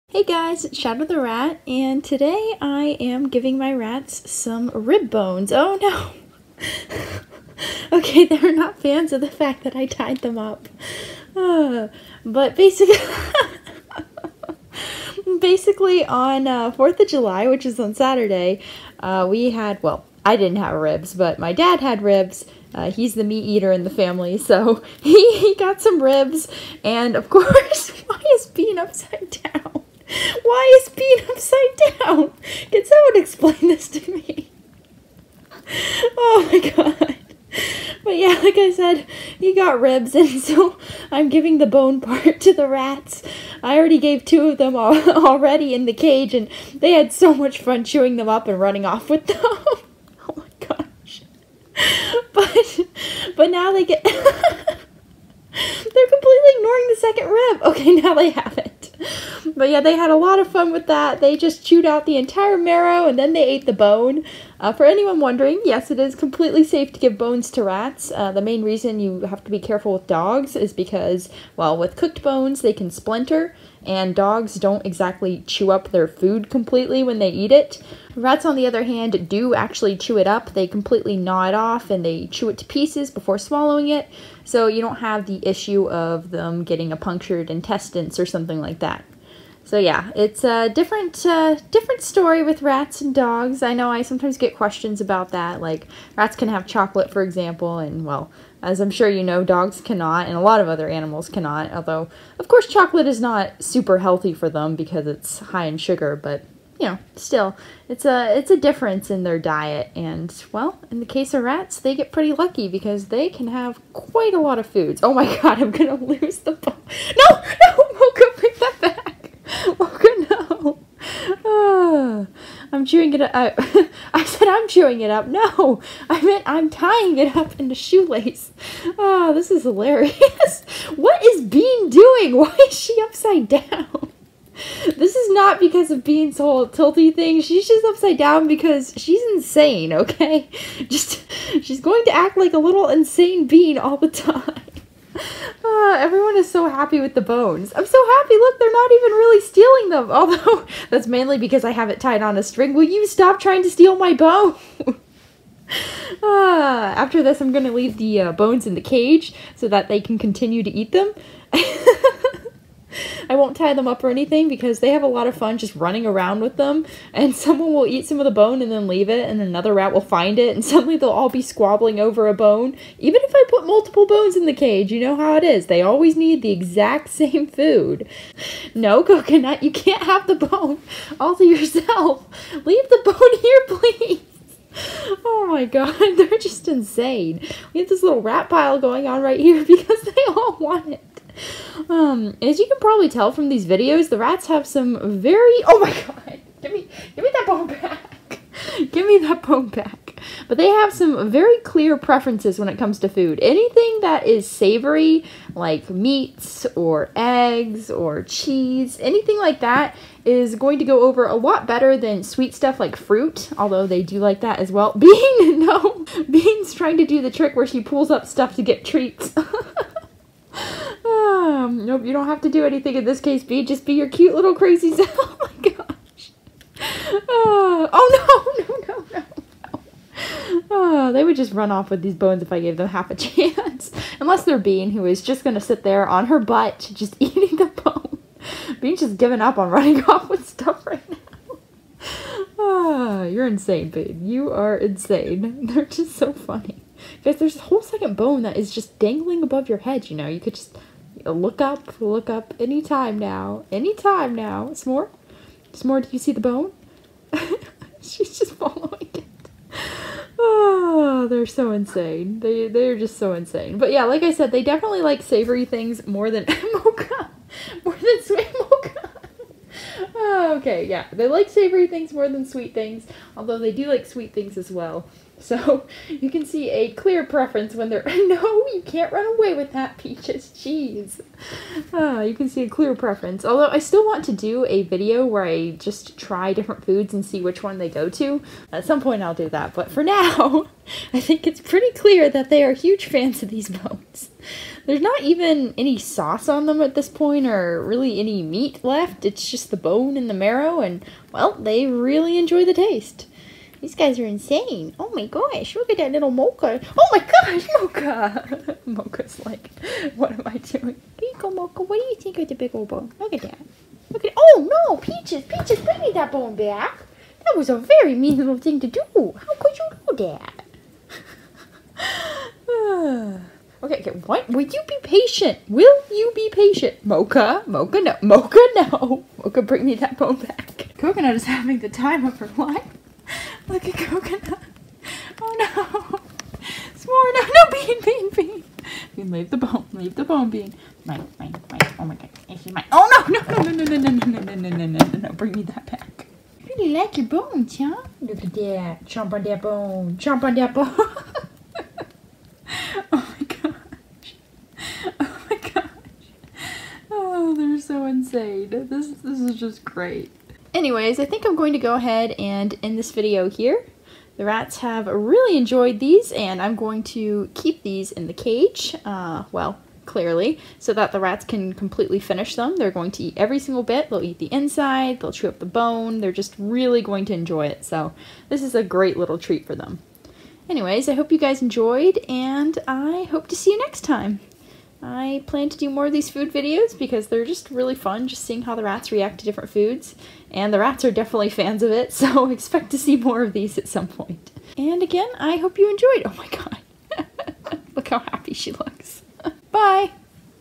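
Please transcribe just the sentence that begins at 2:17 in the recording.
She's just upside down because she's insane, okay?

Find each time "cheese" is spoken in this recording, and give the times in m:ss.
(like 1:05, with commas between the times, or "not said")
3:28, 4:40.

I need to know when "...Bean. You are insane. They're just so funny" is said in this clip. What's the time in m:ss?
4:03.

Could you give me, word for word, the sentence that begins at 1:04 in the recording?
Uh, for anyone wondering, yes, it is completely safe to give bones to rats.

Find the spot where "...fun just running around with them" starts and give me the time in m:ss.
2:45.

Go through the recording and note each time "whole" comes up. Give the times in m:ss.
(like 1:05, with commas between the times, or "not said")
2:16, 4:07.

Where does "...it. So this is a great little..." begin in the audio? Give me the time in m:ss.
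6:17.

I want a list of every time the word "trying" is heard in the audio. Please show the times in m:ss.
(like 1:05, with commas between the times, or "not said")
2:33, 3:36.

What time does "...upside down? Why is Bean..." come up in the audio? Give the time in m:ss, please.
0:28.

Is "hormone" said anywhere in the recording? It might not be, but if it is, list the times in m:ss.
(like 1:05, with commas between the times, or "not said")
not said.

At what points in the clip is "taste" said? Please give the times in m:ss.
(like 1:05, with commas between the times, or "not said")
5:02.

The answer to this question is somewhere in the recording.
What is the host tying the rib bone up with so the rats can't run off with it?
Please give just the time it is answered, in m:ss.
2:07.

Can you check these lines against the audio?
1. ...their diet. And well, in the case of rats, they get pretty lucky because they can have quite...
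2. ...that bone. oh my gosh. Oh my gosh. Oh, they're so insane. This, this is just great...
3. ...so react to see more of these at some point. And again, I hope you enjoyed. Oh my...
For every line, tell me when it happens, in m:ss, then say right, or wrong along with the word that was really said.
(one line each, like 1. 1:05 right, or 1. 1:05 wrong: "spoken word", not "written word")
1. 1:49 right
2. 5:50 right
3. 6:32 wrong: "expect", not "react".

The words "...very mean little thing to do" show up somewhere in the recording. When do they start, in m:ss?
5:17.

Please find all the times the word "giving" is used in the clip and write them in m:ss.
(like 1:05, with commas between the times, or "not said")
0:03, 0:41, 3:59.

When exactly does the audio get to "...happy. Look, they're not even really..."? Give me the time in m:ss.
2:28.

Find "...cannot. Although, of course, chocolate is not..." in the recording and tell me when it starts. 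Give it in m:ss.
1:41.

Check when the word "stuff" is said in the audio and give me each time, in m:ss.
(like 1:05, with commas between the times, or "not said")
3:32, 3:38, 4:00.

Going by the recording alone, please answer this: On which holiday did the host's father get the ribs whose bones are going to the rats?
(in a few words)
4th of July.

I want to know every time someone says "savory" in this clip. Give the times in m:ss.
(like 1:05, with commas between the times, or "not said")
3:24, 4:25, 4:31.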